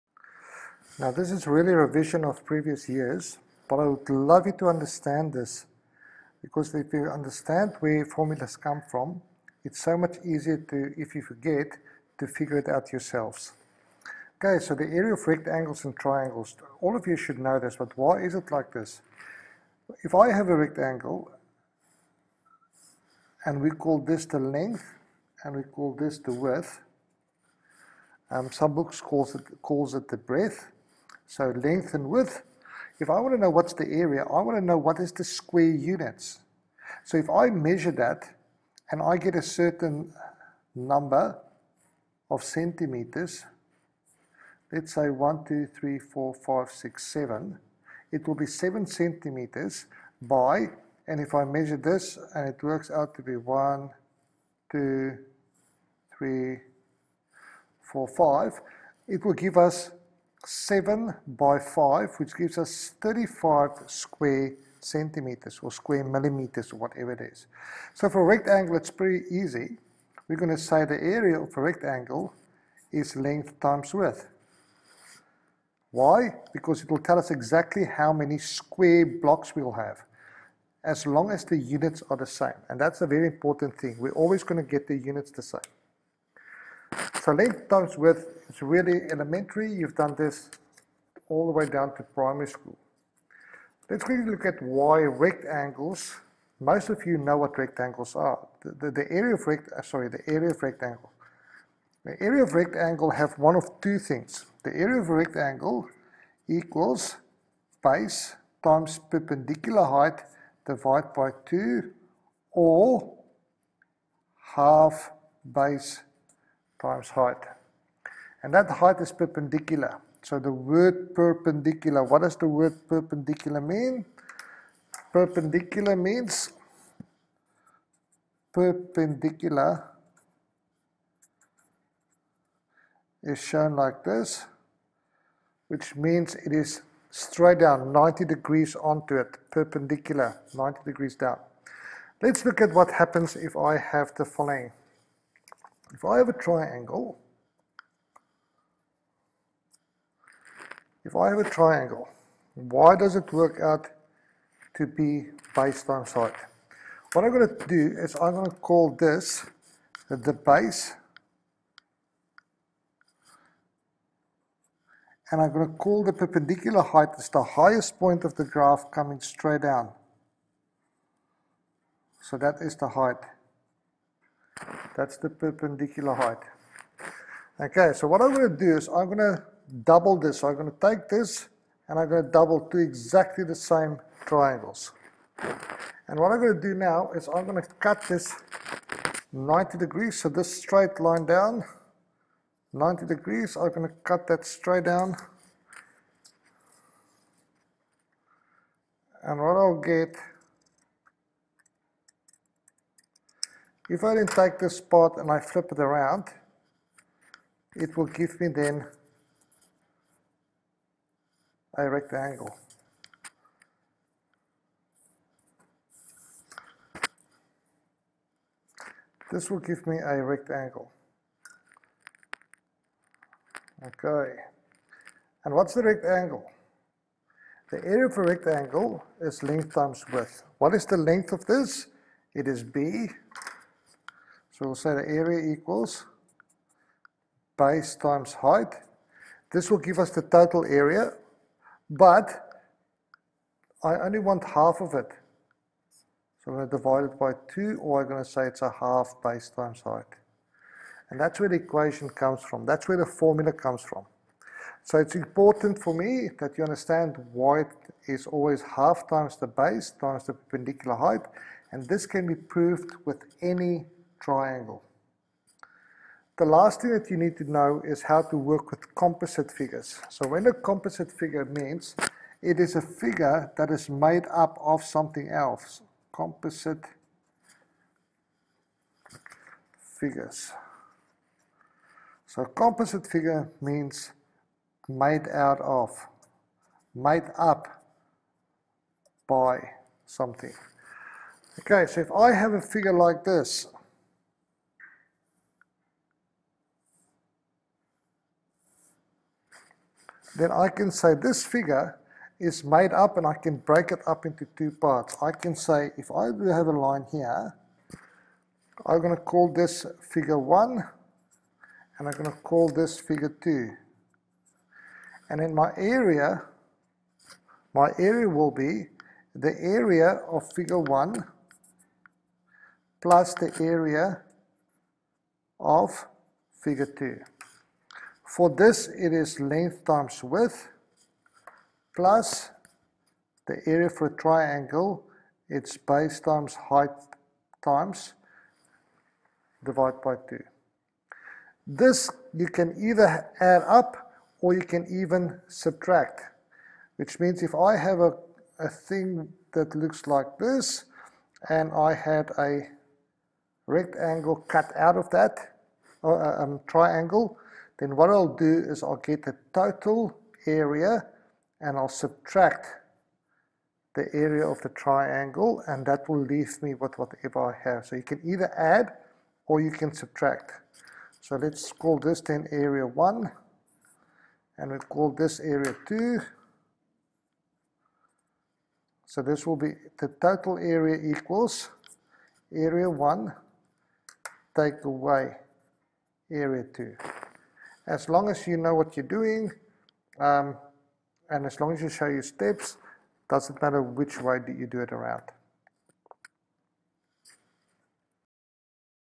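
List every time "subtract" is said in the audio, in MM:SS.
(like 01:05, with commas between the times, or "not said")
05:45, 06:01, 06:09.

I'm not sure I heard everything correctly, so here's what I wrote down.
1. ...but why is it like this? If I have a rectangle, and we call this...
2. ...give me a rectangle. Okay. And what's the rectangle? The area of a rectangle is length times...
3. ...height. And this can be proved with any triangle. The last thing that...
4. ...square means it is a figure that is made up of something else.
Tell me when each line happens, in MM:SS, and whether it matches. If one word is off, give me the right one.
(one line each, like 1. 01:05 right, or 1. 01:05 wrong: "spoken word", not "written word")
1. 00:17 right
2. 03:39 right
3. 04:20 right
4. 04:31 wrong: "figure", not "square".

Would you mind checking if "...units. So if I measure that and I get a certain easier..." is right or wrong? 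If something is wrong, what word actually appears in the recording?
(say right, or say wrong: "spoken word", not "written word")
wrong: "number", not "easier".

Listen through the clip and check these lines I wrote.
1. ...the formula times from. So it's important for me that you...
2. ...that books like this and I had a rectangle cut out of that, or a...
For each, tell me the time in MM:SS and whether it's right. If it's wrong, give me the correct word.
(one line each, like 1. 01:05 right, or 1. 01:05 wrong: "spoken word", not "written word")
1. 04:12 wrong: "comes", not "times"
2. 05:49 wrong: "looks", not "books".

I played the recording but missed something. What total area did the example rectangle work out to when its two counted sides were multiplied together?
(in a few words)
35 square centimeters.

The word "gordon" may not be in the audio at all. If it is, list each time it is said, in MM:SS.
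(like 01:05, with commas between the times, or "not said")
not said.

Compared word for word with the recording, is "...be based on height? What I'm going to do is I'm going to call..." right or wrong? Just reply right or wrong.
right.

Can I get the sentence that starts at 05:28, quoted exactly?
For this, it is length times width plus the area for a triangle, its base times height times divided by 2.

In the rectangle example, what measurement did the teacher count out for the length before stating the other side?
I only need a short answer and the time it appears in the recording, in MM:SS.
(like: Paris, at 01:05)
7 centimeters, at 00:48.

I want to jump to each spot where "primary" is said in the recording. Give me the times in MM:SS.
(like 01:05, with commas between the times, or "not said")
01:32.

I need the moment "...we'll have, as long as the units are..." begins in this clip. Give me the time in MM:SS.
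01:19.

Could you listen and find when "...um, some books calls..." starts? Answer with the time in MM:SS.
00:28.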